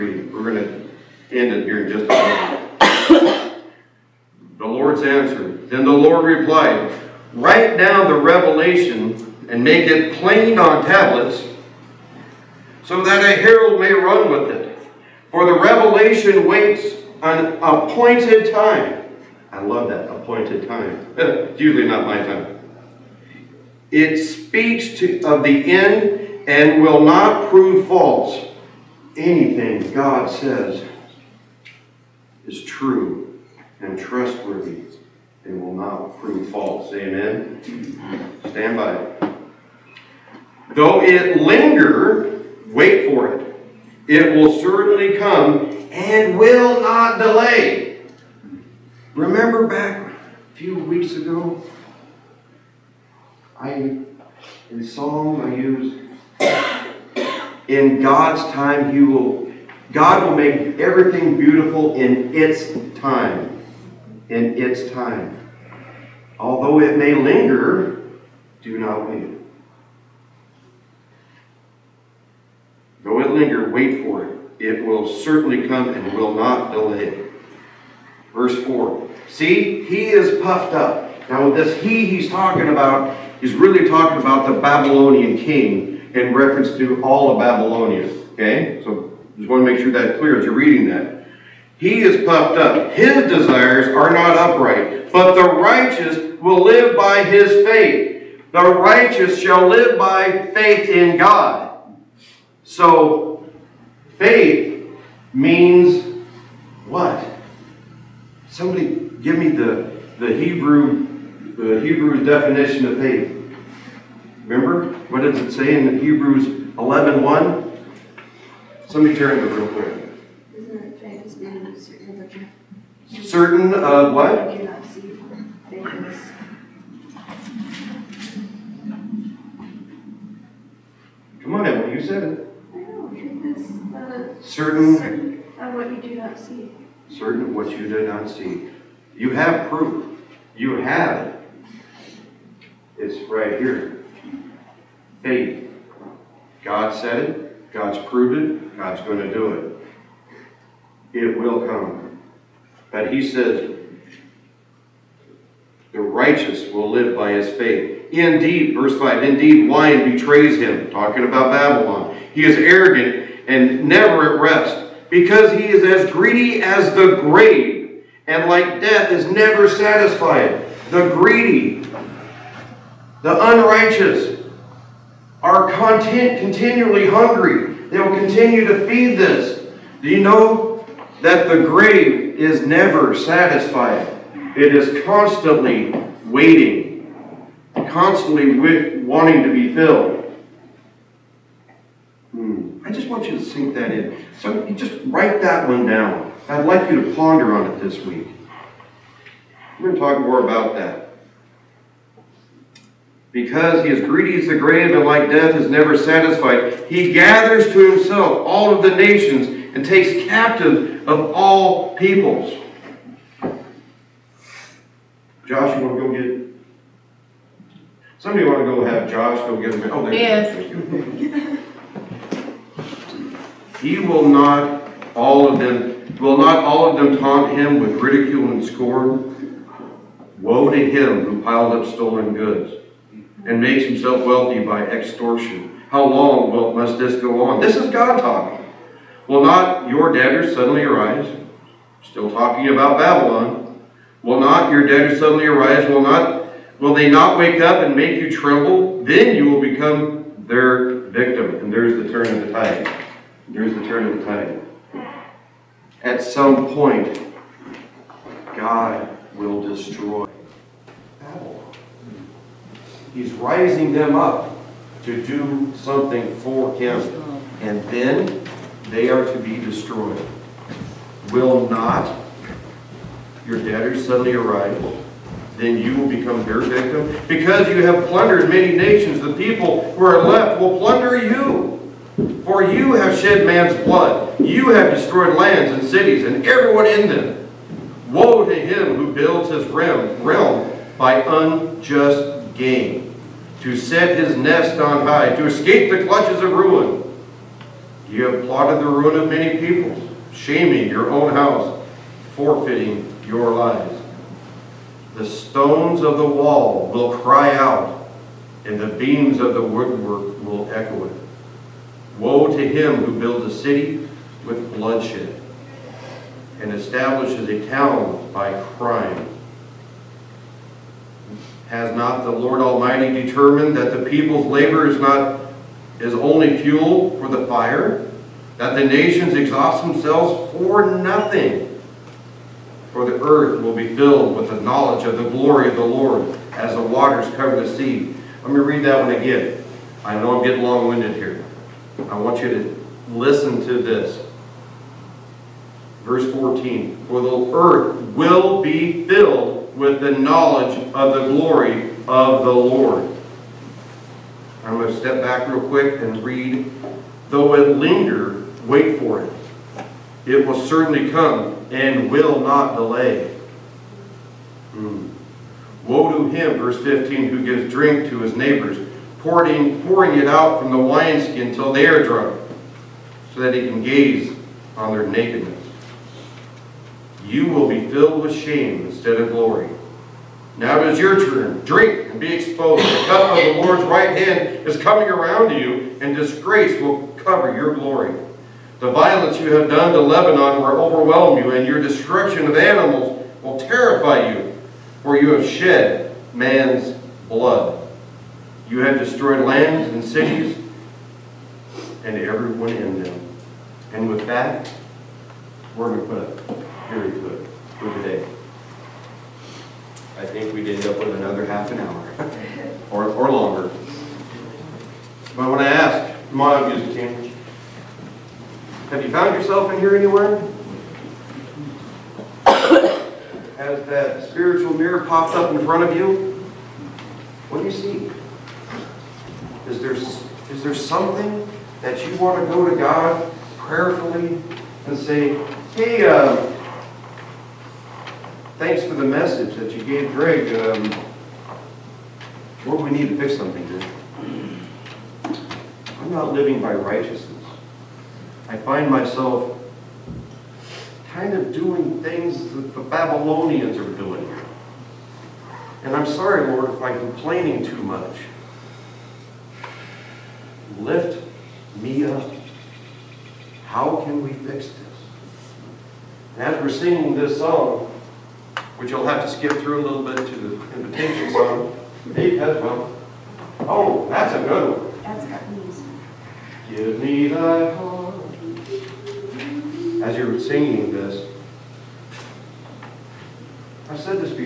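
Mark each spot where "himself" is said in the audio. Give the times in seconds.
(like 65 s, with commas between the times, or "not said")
207 s, 233 s.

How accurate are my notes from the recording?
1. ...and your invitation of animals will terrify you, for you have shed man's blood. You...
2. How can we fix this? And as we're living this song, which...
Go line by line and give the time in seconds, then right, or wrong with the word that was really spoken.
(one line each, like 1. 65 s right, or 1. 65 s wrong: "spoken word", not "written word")
1. 391 s wrong: "destruction", not "invitation"
2. 463 s wrong: "singing", not "living".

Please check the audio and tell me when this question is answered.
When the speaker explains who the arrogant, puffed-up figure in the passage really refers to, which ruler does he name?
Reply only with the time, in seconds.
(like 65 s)
84 s.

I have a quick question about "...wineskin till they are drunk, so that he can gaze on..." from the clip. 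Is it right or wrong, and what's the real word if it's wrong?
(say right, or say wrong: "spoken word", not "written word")
right.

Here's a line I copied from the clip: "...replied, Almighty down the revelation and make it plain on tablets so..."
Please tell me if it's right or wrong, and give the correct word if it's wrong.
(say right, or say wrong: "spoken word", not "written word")
wrong: "Write", not "Almighty".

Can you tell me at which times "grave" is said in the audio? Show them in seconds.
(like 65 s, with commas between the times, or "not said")
167 s, 181 s, 204 s.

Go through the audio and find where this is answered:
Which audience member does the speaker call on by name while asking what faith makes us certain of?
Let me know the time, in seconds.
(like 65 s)
131 s.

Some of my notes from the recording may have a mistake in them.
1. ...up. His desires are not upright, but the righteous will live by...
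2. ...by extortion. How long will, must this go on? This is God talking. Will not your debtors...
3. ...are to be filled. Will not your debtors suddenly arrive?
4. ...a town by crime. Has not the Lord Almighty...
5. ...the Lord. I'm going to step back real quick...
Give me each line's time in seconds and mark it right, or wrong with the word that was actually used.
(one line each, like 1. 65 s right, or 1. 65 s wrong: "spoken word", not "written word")
1. 92 s right
2. 234 s right
3. 269 s wrong: "destroyed", not "filled"
4. 317 s right
5. 352 s right.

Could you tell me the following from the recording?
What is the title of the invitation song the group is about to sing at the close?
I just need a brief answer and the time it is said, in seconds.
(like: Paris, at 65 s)
Give Me Thy Heart, at 476 s.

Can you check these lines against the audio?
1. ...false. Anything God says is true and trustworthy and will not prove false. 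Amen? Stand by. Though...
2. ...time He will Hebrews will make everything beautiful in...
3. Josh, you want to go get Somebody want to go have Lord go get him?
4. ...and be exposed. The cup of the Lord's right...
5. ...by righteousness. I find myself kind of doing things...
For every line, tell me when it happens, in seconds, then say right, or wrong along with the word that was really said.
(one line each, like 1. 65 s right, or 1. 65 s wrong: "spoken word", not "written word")
1. 27 s right
2. 58 s wrong: "God", not "Hebrews"
3. 215 s wrong: "Josh", not "Lord"
4. 382 s right
5. 446 s right.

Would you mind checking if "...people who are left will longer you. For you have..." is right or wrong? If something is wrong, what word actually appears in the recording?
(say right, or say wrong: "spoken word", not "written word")
wrong: "plunder", not "longer".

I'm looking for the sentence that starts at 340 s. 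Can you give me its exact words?
I know I'm getting long-winded here.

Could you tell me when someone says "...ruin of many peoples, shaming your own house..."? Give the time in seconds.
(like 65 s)
298 s.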